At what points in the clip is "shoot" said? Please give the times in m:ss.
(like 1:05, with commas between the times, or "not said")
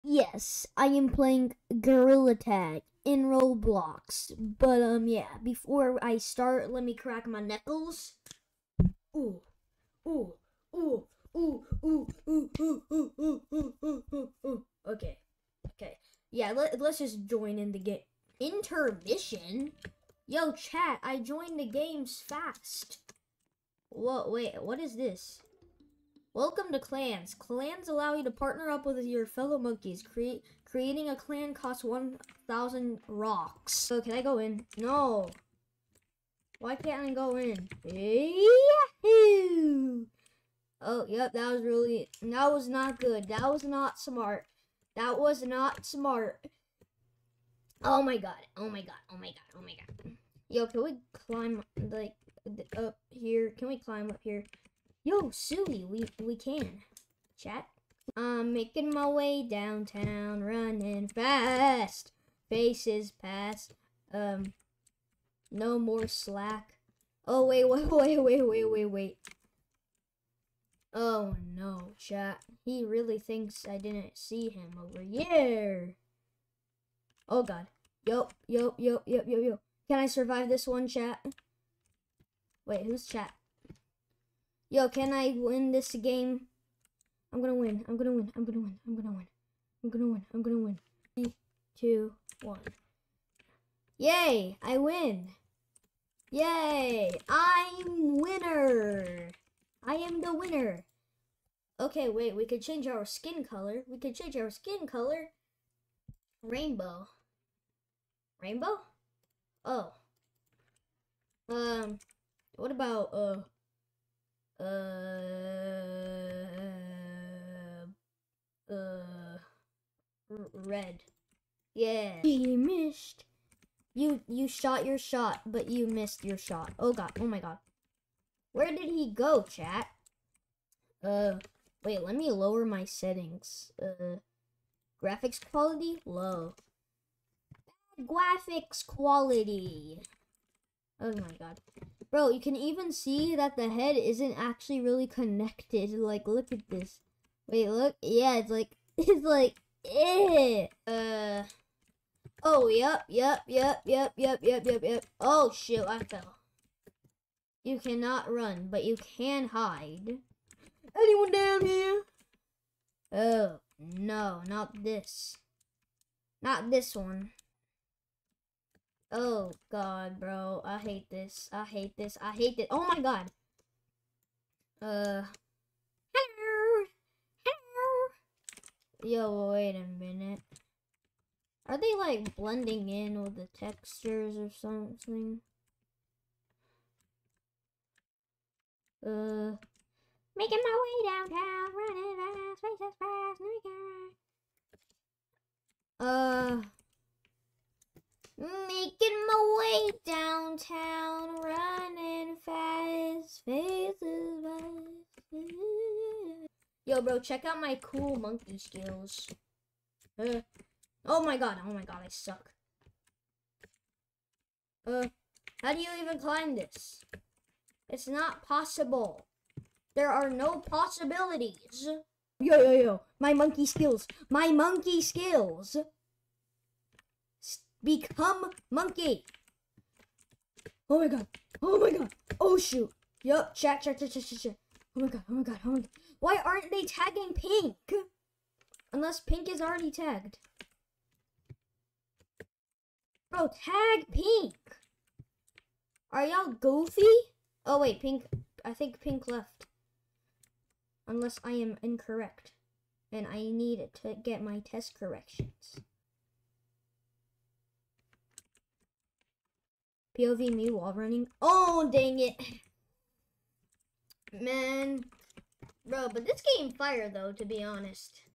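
2:35, 3:52.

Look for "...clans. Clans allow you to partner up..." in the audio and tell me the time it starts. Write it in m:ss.
0:26.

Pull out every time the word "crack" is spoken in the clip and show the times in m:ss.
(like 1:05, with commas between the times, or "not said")
0:06.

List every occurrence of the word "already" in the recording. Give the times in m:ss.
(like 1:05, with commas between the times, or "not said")
3:59.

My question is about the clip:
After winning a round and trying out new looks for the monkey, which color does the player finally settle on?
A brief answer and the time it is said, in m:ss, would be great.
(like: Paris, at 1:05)
Red, at 2:00.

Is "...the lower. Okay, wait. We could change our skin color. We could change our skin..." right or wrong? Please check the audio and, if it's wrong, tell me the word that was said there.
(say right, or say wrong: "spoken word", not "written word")
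wrong: "winner", not "lower".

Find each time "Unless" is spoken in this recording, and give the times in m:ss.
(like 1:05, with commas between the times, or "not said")
3:58, 4:11.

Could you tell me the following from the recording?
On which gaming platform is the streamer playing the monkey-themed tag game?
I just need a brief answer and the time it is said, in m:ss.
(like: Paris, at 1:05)
Roblox, at 0:03.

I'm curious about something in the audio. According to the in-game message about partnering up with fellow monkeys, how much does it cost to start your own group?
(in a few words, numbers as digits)
1,000 rocks.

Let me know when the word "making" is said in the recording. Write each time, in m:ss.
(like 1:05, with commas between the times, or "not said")
0:58, 3:10.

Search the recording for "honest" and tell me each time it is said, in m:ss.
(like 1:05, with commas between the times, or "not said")
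4:27.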